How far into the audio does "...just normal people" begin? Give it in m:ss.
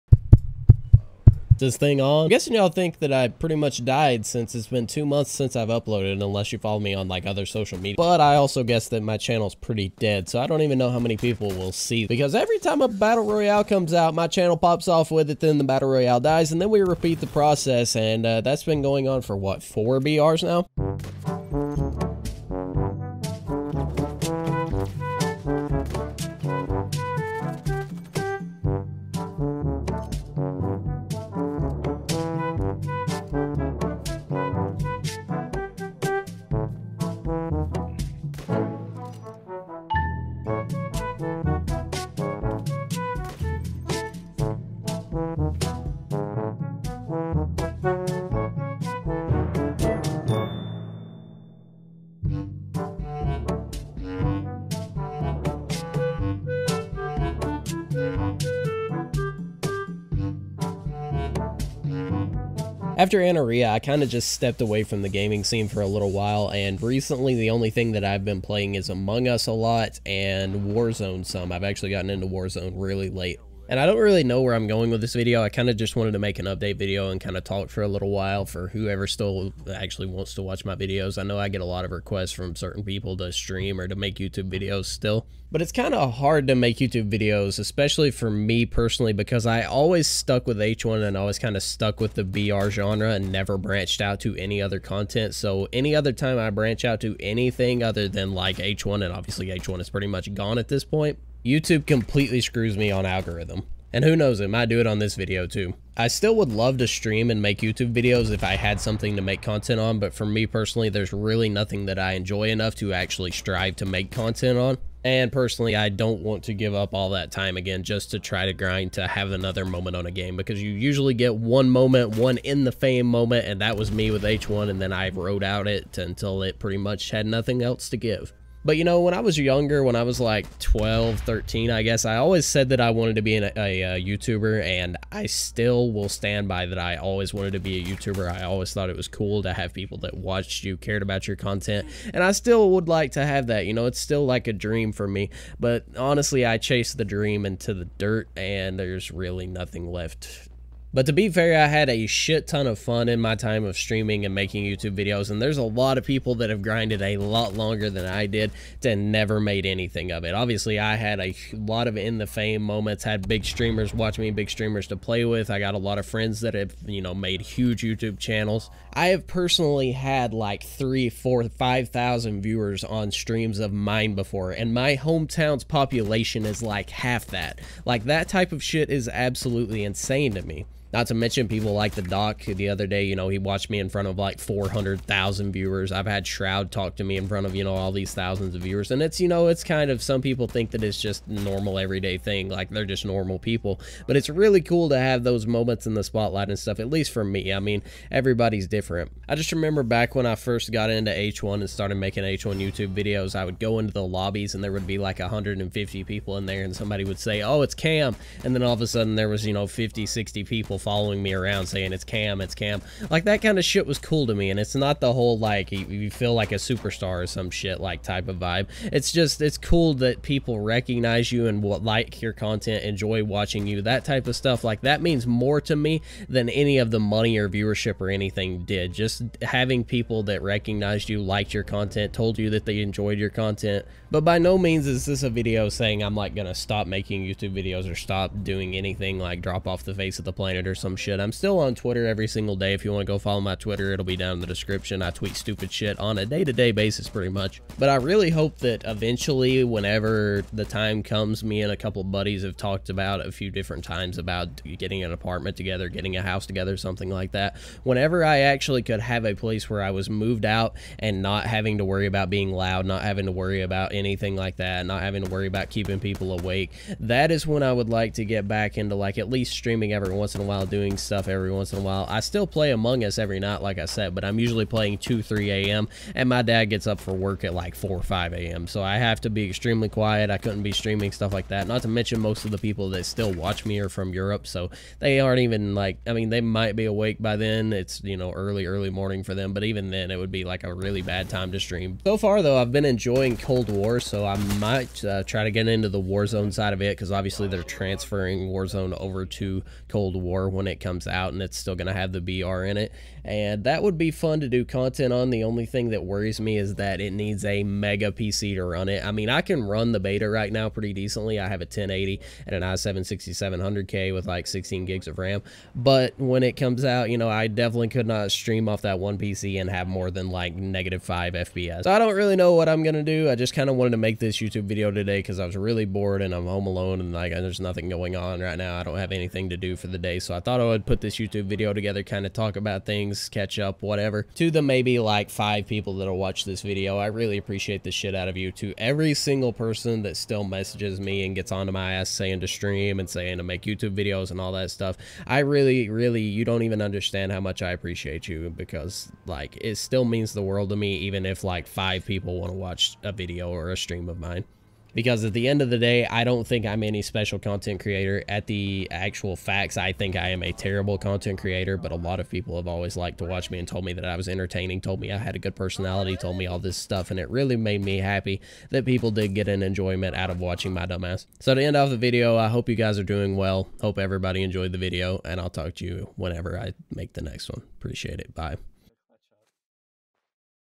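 3:12.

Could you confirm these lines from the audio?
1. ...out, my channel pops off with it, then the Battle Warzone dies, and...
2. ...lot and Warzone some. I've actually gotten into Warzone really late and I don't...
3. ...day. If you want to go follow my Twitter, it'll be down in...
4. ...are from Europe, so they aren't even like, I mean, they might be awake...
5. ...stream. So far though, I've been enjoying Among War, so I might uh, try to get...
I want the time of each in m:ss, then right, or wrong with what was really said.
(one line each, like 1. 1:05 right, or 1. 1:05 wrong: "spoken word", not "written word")
1. 0:13 wrong: "Royale", not "Warzone"
2. 1:09 right
3. 4:02 right
4. 4:43 right
5. 4:51 wrong: "Cold", not "Among".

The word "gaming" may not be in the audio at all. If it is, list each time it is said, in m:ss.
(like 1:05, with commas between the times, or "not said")
1:05.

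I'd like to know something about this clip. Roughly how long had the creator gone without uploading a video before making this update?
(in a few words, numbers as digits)
2 months.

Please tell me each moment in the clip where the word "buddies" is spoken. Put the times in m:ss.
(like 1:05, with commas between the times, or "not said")
4:12.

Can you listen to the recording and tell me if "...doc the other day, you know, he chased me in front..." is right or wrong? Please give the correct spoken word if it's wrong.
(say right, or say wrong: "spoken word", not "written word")
wrong: "watched", not "chased".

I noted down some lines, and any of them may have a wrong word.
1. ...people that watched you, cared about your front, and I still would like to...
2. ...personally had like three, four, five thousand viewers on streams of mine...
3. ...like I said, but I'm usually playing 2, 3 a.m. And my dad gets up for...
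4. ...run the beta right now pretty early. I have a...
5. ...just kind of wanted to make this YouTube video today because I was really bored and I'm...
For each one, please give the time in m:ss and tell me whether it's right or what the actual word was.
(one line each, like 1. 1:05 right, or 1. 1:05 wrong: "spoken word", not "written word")
1. 2:19 wrong: "content", not "front"
2. 2:49 right
3. 4:33 right
4. 5:09 wrong: "decently", not "early"
5. 5:23 right.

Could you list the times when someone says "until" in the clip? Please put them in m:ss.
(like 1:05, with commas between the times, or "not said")
2:05.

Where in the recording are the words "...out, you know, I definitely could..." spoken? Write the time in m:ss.
5:16.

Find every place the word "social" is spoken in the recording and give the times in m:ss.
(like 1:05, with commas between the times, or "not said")
0:07.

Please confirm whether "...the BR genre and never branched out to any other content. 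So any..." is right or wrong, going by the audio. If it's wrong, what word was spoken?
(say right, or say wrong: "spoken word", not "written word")
right.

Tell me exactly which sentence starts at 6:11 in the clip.
So to end off the video, I hope you guys are doing well.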